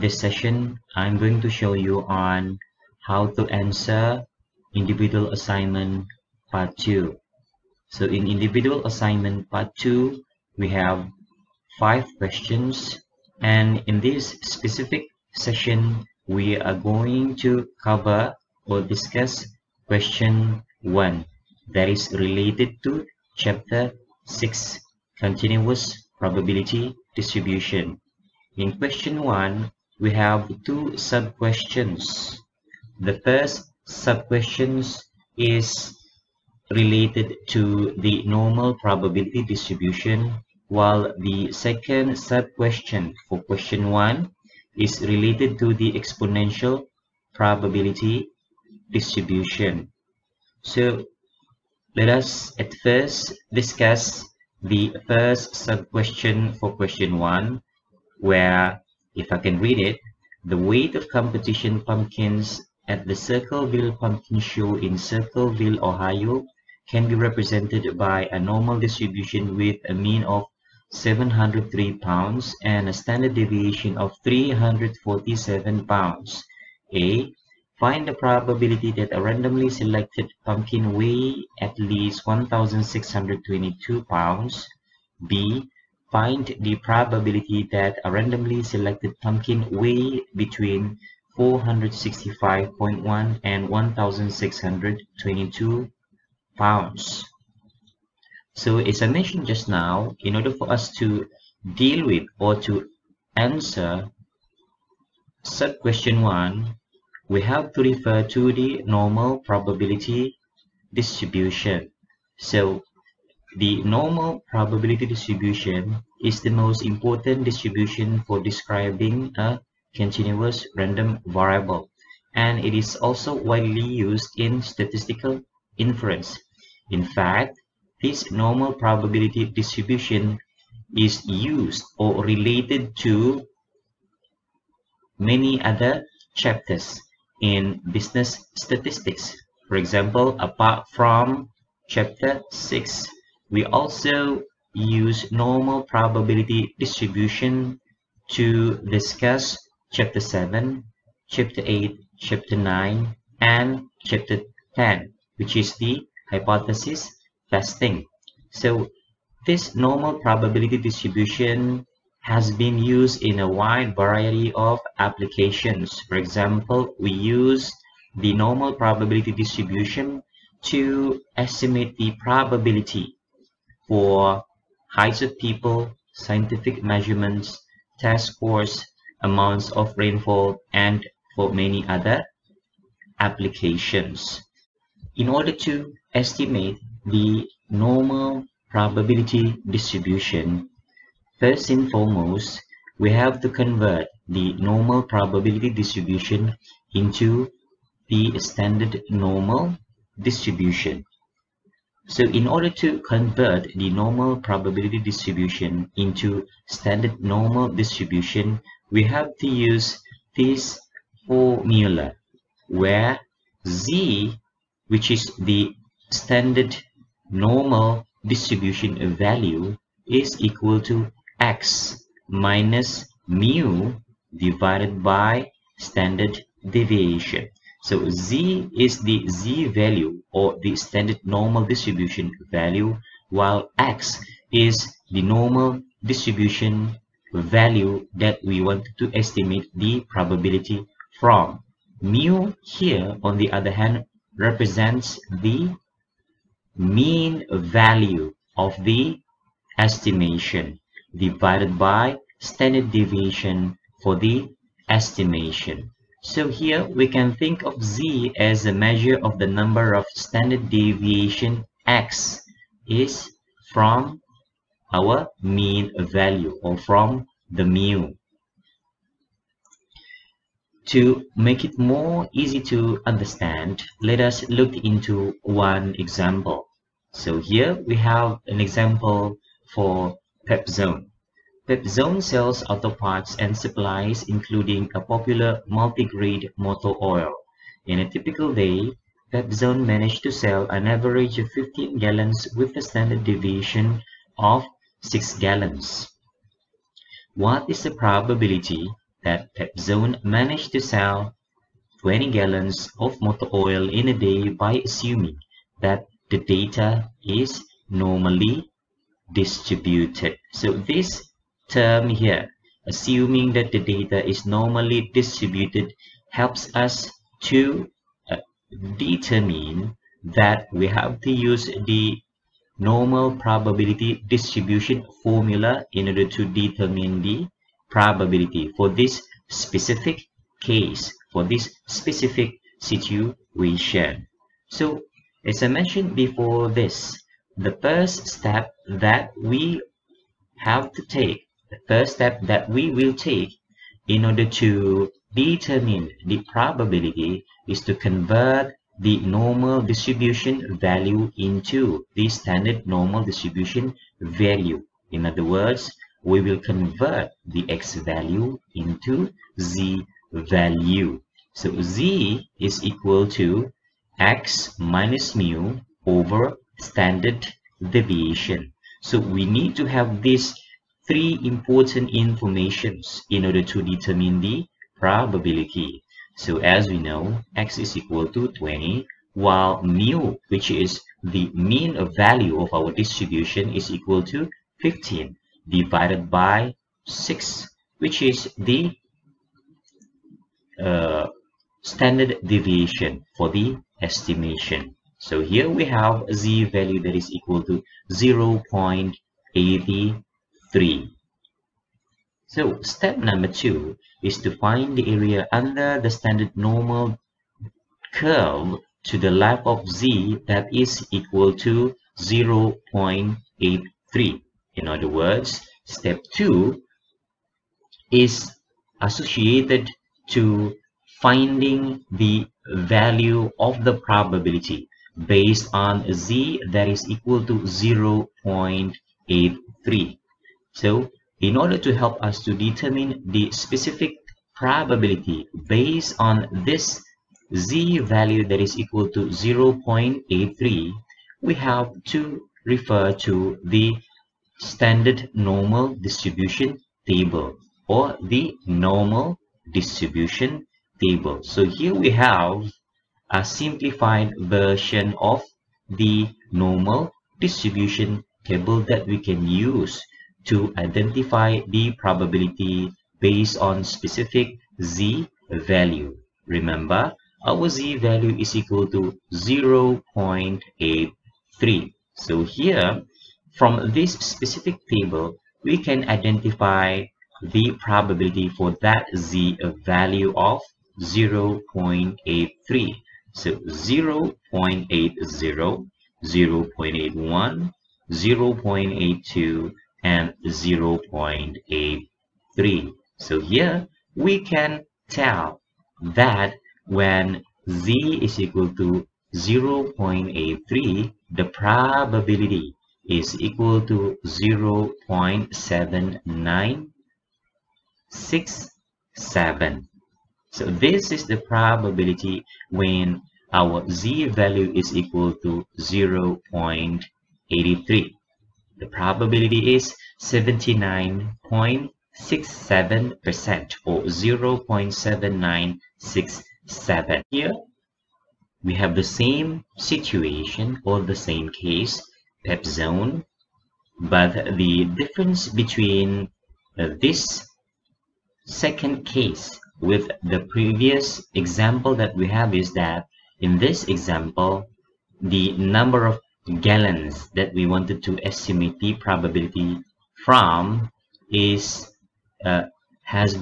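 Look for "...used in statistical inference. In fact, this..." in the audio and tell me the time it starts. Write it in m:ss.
2:03.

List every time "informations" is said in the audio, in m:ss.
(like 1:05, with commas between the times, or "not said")
6:12.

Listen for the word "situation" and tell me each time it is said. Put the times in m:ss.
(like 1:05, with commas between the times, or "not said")
5:32, 8:49.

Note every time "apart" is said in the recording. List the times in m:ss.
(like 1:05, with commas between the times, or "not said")
2:20.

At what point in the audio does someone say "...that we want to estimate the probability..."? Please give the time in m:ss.
3:58.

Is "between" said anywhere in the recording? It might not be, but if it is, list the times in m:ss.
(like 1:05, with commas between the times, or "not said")
1:30, 8:55.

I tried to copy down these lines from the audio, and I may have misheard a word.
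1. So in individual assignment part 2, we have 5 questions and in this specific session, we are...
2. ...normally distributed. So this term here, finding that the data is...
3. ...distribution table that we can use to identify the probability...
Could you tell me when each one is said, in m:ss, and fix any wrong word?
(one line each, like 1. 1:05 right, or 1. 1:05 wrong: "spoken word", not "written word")
1. 0:07 right
2. 5:07 wrong: "assuming", not "finding"
3. 7:37 right.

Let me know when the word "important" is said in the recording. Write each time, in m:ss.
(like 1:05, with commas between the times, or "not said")
1:56, 6:11.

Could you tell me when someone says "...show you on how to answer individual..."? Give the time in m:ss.
0:01.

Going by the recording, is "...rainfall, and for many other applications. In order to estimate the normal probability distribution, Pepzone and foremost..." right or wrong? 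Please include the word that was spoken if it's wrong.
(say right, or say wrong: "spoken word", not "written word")
wrong: "First", not "Pepzone".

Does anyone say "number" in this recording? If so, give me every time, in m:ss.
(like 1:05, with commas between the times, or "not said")
4:19, 6:43, 9:05.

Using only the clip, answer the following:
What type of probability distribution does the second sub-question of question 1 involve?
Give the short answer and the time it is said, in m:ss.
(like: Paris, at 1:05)
Exponential, at 0:45.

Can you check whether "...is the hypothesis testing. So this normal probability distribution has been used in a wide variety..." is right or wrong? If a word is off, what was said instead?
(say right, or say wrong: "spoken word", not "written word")
right.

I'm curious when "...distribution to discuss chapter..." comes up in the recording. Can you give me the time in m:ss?
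2:26.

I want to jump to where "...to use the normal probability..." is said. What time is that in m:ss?
5:21.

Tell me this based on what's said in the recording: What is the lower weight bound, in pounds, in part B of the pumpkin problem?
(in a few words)
465.1.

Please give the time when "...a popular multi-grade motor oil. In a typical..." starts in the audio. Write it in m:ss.
4:44.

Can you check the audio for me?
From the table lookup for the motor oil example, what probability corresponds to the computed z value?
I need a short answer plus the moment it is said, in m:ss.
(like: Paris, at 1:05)
0.7967, at 8:44.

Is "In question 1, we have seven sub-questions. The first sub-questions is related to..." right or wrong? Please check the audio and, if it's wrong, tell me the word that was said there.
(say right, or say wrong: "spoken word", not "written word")
wrong: "two", not "seven".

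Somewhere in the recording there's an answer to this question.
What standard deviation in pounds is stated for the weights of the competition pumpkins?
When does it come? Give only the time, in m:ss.
1:14.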